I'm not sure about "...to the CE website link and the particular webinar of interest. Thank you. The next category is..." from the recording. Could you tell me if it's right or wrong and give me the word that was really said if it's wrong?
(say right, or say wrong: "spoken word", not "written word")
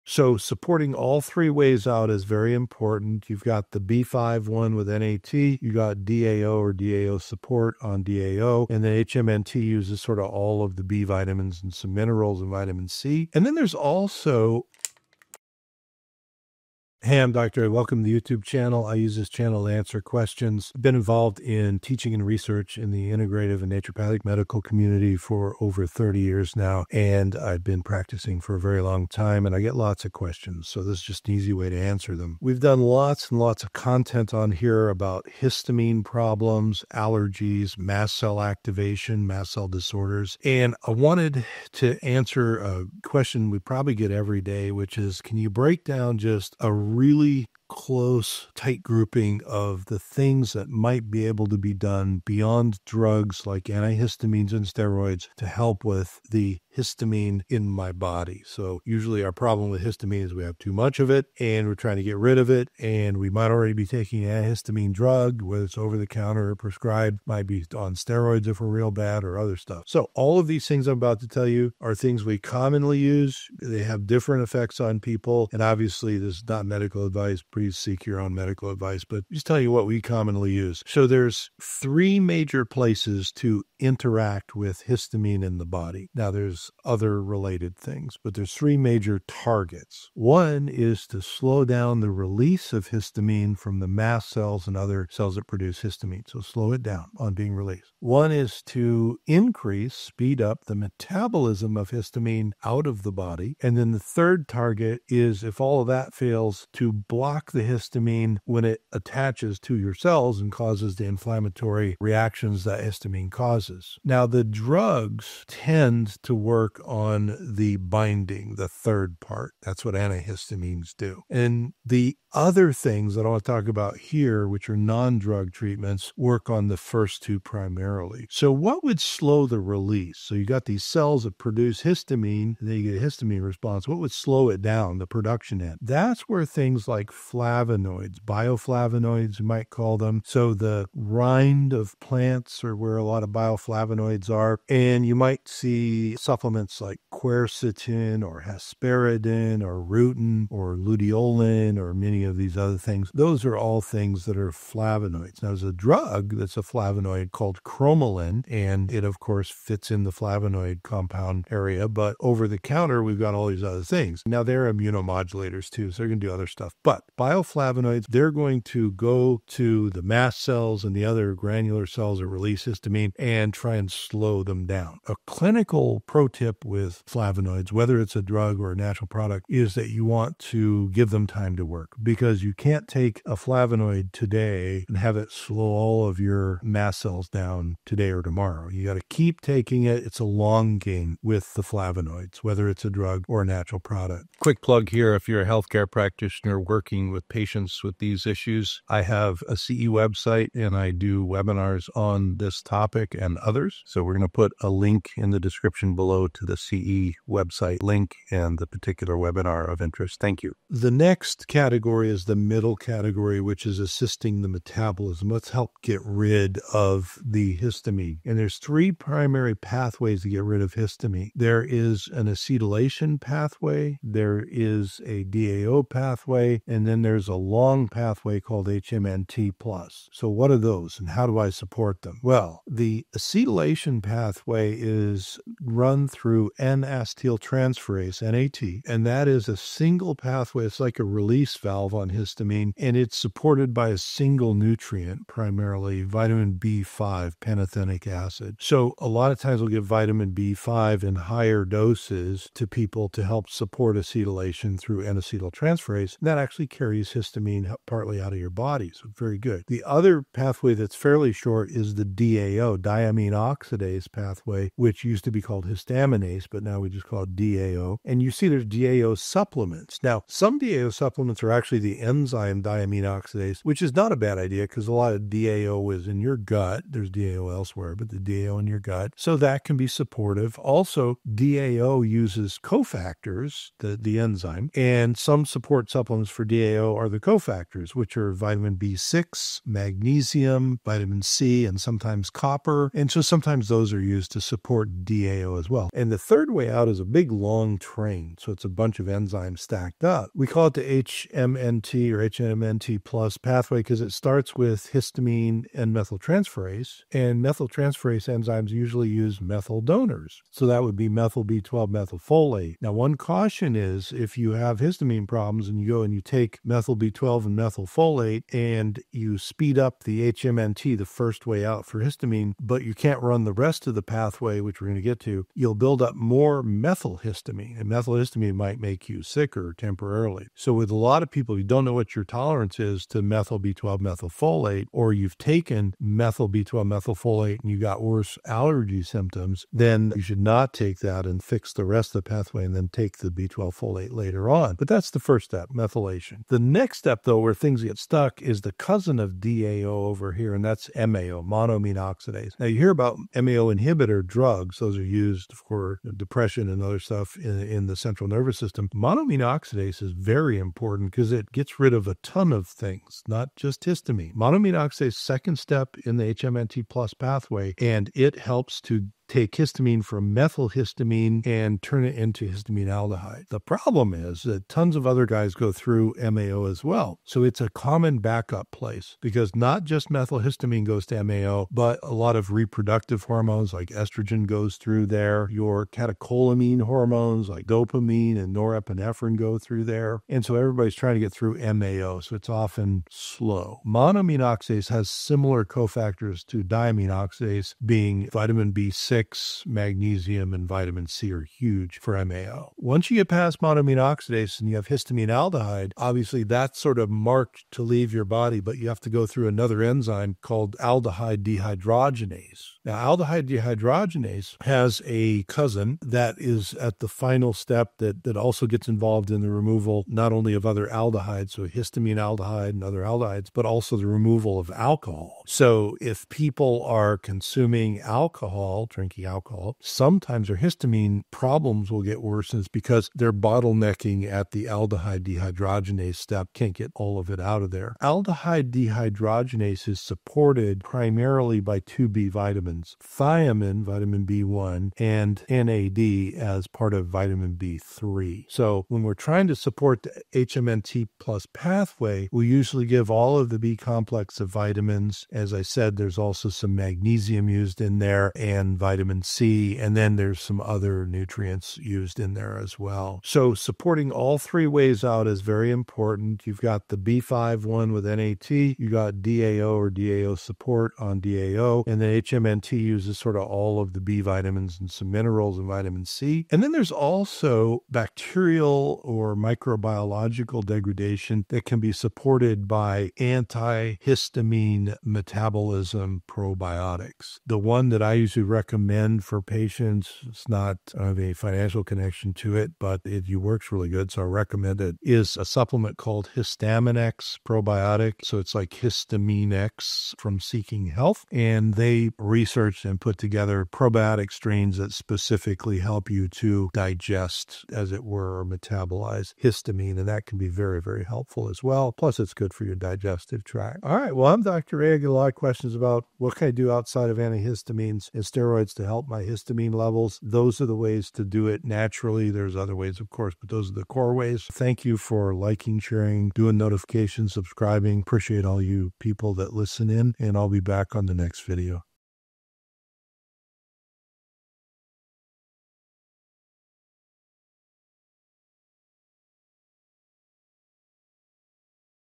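right.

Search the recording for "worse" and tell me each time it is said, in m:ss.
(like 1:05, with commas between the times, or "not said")
5:38, 7:12.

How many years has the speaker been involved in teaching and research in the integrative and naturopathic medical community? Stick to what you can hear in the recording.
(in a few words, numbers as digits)
over 30 years.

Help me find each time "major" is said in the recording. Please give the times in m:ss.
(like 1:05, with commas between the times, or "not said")
1:22, 1:28.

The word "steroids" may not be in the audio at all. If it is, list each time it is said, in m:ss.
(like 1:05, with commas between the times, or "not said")
0:54, 1:07, 8:38.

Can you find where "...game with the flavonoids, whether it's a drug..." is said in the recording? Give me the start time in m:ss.
3:10.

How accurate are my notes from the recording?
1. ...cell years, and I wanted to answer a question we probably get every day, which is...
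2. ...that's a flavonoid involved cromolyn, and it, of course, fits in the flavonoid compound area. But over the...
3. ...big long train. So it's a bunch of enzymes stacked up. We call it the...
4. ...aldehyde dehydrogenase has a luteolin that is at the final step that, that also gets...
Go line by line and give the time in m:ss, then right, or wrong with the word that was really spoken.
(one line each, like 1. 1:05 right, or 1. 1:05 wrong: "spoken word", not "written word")
1. 0:39 wrong: "disorders", not "years"
2. 2:36 wrong: "called", not "involved"
3. 4:57 right
4. 6:53 wrong: "cousin", not "luteolin".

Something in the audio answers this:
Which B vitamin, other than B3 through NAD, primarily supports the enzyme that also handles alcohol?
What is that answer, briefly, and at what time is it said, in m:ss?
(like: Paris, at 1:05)
thiamine, at 7:23.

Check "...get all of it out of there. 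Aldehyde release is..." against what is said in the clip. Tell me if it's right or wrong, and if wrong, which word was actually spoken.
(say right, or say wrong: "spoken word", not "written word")
wrong: "dehydrogenase", not "release".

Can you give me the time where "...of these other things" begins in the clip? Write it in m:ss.
2:32.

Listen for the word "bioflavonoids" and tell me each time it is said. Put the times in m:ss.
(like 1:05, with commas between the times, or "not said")
2:18, 2:23, 2:47.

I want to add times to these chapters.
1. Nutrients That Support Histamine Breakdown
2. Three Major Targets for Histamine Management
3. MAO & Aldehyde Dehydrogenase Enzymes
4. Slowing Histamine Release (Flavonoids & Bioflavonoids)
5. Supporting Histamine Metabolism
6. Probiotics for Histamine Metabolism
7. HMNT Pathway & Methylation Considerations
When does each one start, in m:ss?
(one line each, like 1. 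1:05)
1. 7:11
2. 0:34
3. 5:33
4. 1:39
5. 3:17
6. 7:48
7. 3:53.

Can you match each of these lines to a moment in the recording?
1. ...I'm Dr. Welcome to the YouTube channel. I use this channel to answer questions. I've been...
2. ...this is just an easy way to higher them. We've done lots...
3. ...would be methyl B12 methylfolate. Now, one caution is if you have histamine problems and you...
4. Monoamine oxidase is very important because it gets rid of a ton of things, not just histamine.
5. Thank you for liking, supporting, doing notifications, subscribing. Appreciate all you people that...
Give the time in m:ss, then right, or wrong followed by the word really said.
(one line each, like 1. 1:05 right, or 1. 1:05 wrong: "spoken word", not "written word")
1. 0:17 right
2. 0:30 wrong: "answer", not "higher"
3. 5:10 right
4. 5:58 right
5. 8:44 wrong: "sharing", not "supporting".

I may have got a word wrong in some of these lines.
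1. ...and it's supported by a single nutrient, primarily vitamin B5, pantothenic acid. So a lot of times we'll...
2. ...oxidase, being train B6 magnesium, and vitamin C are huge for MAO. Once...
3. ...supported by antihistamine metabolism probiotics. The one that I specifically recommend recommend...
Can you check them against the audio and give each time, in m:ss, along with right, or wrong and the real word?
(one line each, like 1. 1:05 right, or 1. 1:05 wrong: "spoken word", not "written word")
1. 4:02 right
2. 6:37 wrong: "vitamin", not "train"
3. 8:01 wrong: "usually", not "specifically".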